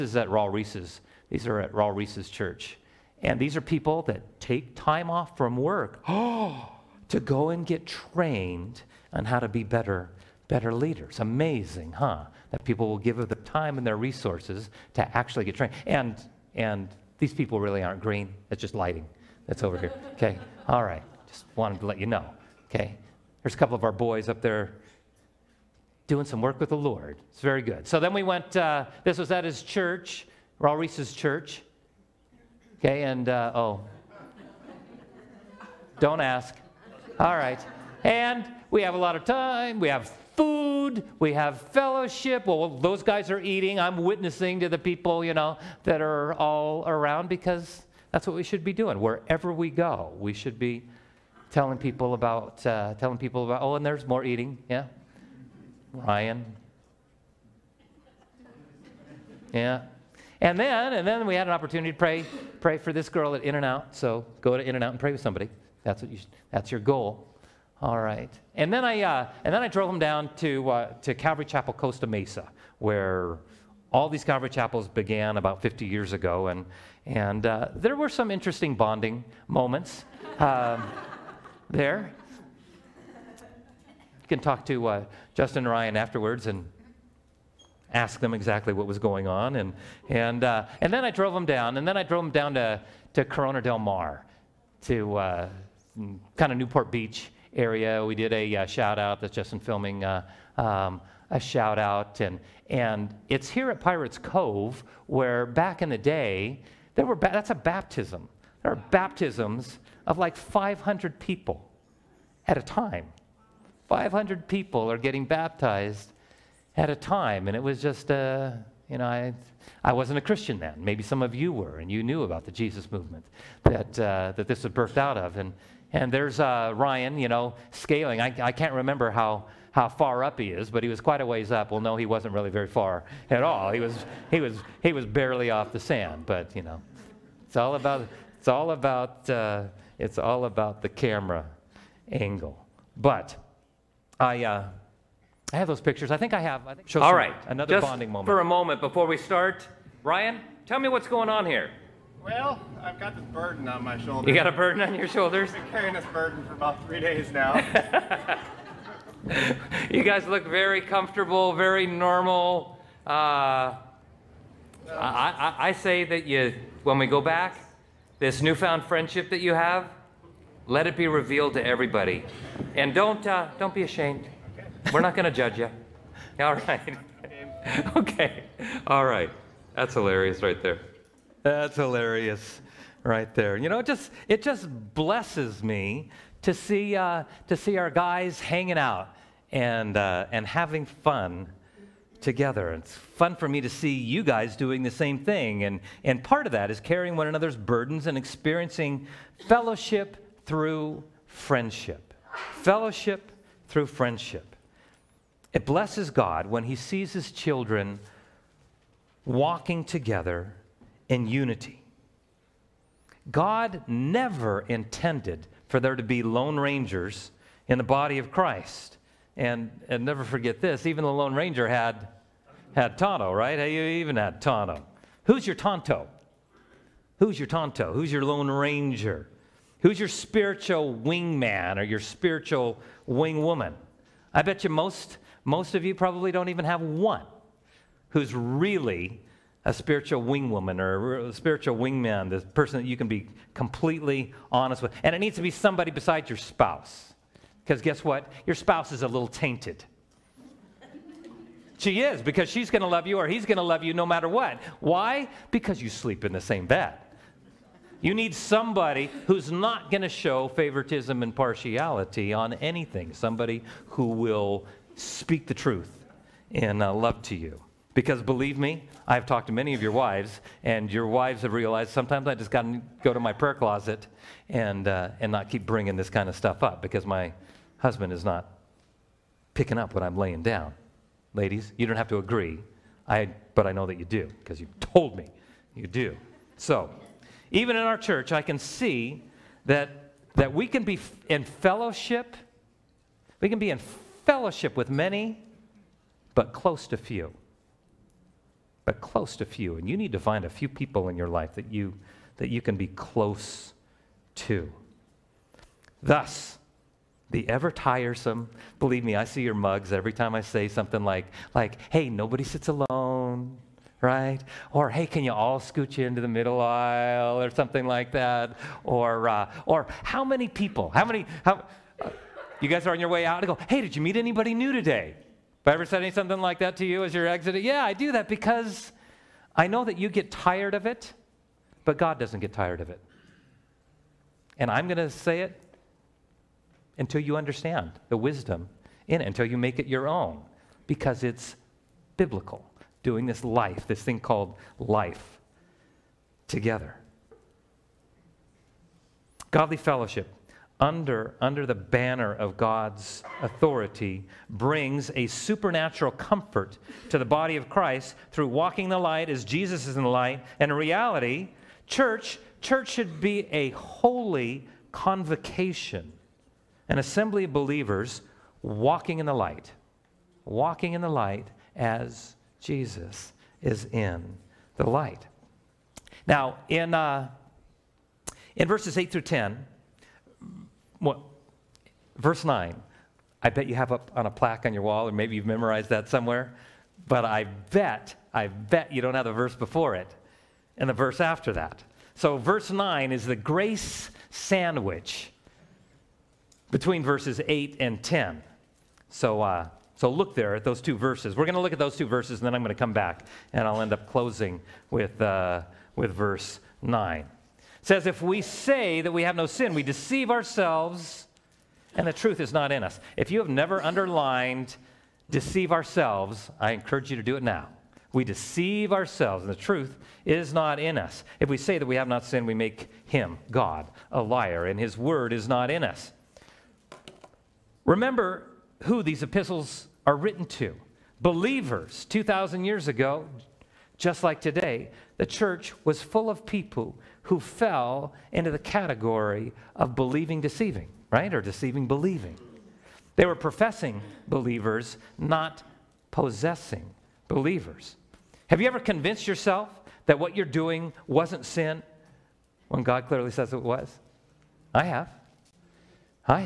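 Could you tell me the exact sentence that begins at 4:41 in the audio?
Ladies, you don't have to agree, I, but I know that you do because you told me you do.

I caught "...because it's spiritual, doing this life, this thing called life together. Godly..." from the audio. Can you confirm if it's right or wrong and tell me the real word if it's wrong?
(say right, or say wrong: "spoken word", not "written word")
wrong: "biblical", not "spiritual".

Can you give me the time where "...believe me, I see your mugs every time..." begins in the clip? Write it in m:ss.
5:08.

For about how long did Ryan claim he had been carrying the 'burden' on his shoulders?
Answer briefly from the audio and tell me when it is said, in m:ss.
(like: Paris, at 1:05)
3 days, at 2:36.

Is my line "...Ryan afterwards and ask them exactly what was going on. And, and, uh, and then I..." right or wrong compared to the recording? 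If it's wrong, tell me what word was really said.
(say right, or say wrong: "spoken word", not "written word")
right.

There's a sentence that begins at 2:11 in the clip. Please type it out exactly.
Well, no, he wasn't really very far at all.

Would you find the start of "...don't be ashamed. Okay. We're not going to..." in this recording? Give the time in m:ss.
2:53.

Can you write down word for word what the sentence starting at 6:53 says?
If you have never underlined deceive ourselves, I encourage you to do it now.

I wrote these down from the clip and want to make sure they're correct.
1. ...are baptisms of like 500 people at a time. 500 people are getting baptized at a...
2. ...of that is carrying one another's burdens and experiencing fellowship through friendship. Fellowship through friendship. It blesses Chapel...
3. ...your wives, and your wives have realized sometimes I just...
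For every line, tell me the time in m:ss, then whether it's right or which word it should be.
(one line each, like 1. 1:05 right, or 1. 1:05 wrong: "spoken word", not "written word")
1. 1:48 right
2. 3:16 wrong: "God", not "Chapel"
3. 4:29 right.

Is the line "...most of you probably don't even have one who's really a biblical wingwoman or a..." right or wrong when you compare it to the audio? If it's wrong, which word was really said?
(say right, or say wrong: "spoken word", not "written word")
wrong: "spiritual", not "biblical".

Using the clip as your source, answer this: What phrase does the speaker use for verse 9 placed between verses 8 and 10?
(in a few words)
grace sandwich.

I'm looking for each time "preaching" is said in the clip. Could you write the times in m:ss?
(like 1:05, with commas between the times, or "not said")
not said.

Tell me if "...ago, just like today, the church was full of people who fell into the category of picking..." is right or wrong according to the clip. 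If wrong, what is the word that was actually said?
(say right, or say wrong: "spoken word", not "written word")
wrong: "believing", not "picking".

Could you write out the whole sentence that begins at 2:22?
But I, uh, I have those pictures.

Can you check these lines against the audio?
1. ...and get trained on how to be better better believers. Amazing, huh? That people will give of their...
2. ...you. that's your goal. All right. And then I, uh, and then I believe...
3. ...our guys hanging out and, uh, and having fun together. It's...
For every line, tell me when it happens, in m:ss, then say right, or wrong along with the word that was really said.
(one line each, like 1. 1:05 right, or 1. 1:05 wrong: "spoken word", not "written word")
1. 0:07 wrong: "leaders", not "believers"
2. 1:06 wrong: "drove", not "believe"
3. 3:07 right.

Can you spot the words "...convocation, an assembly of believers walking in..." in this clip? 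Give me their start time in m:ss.
6:04.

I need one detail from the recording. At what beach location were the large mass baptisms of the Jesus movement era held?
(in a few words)
Pirates Cove.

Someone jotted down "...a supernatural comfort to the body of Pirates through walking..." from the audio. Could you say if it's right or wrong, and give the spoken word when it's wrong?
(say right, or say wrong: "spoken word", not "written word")
wrong: "Christ", not "Pirates".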